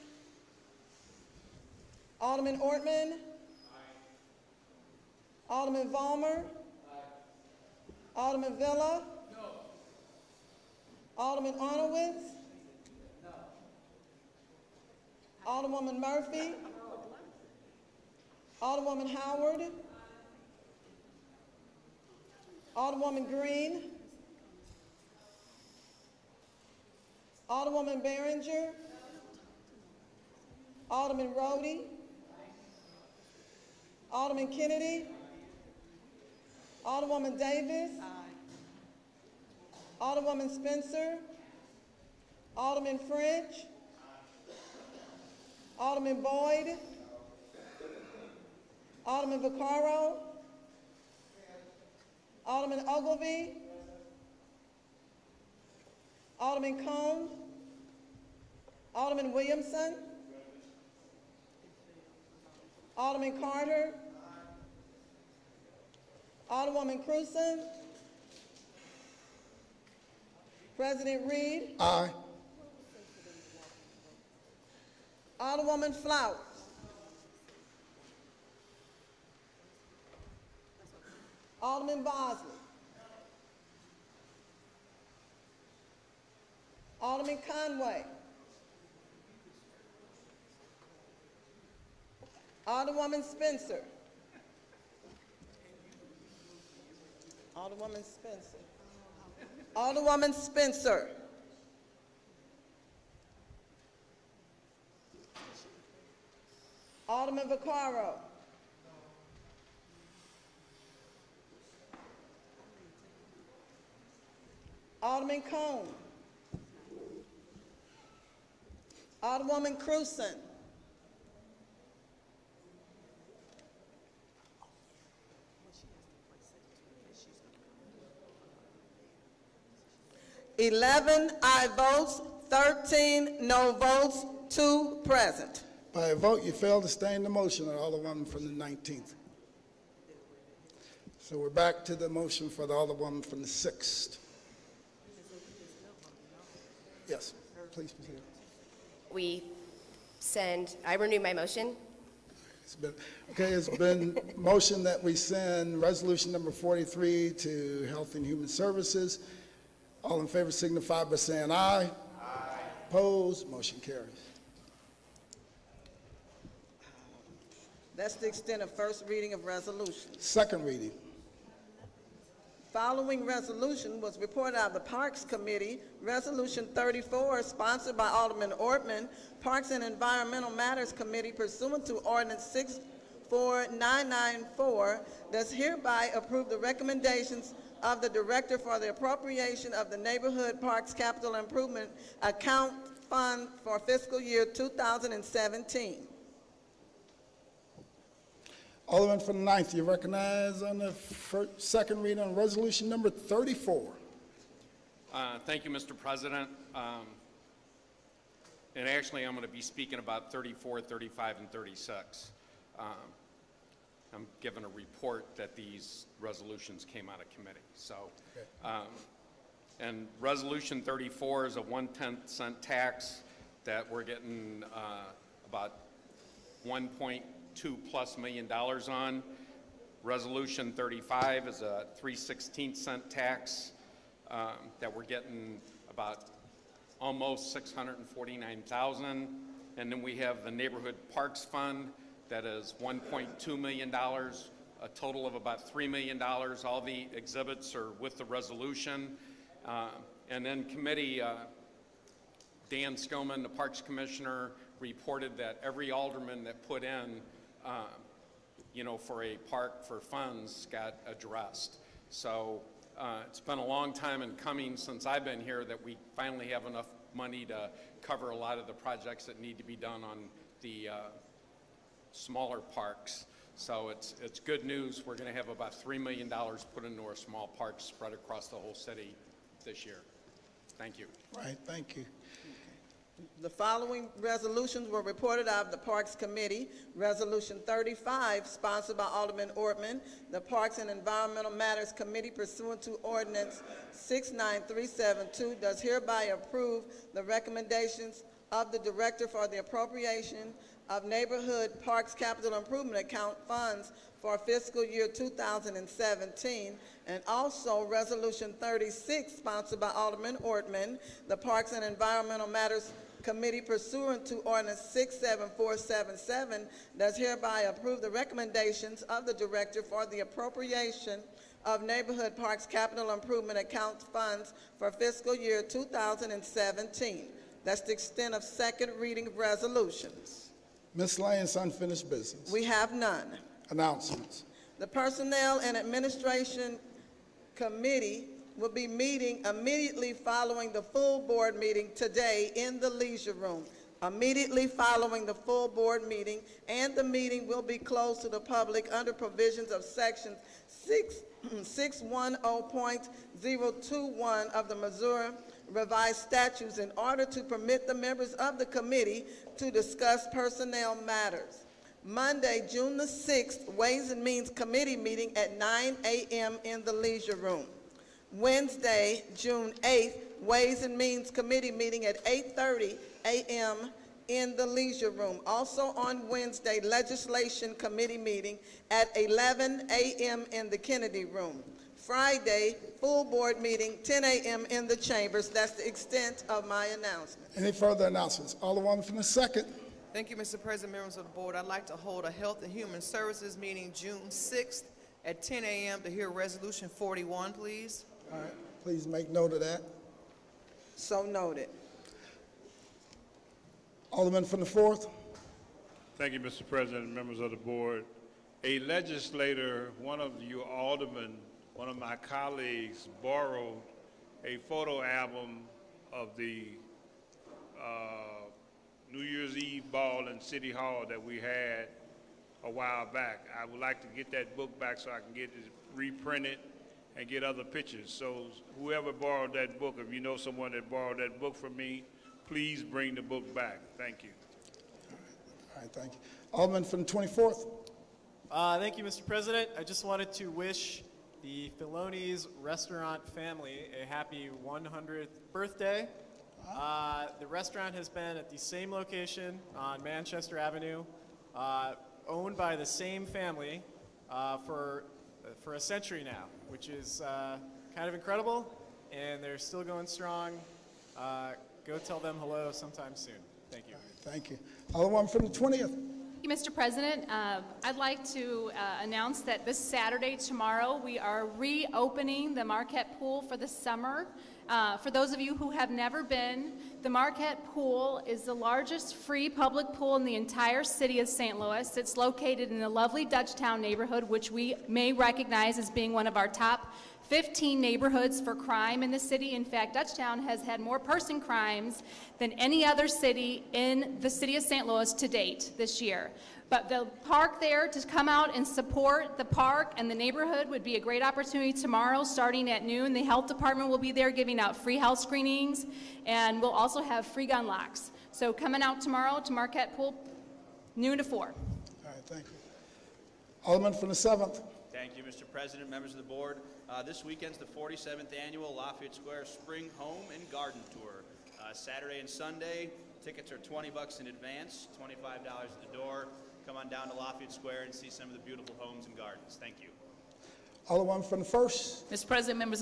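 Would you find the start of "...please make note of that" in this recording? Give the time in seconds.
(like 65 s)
398 s.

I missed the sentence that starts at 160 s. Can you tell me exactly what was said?
All in favor signify by saying aye.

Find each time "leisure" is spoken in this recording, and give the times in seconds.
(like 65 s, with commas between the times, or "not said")
342 s, 366 s, 374 s.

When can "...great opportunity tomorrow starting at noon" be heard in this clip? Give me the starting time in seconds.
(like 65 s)
500 s.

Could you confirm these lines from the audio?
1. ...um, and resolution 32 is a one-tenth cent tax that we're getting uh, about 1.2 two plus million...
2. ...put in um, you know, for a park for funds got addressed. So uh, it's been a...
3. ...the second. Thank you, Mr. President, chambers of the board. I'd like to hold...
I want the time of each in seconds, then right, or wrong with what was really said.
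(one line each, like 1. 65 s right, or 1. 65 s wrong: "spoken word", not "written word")
1. 218 s wrong: "34", not "32"
2. 256 s right
3. 389 s wrong: "members", not "chambers".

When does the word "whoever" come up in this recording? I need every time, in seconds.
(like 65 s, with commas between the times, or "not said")
428 s.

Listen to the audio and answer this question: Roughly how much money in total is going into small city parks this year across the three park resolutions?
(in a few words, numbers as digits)
$3 million.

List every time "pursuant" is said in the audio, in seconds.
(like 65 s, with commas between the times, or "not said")
181 s, 292 s, 313 s.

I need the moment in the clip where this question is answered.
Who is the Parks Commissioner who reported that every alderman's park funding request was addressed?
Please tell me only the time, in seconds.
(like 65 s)
252 s.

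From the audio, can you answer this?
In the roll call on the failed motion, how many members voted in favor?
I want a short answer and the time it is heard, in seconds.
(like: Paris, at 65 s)
11, at 130 s.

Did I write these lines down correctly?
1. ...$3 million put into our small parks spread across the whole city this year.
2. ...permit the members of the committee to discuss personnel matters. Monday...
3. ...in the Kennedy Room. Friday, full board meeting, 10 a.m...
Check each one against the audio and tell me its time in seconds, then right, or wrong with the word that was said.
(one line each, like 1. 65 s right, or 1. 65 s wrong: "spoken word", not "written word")
1. 275 s right
2. 357 s right
3. 380 s right.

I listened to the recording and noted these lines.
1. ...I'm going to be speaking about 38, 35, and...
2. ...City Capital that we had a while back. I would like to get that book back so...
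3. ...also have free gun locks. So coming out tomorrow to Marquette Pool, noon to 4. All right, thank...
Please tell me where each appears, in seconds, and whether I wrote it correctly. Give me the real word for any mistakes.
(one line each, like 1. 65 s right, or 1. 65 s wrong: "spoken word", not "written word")
1. 209 s wrong: "34", not "38"
2. 420 s wrong: "Hall", not "Capital"
3. 506 s right.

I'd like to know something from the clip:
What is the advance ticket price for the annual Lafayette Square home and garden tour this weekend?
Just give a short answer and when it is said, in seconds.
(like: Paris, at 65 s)
$20, at 523 s.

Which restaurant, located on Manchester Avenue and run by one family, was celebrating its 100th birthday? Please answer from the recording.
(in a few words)
Failoni's.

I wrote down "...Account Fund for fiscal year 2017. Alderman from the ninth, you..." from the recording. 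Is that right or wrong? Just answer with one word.
right.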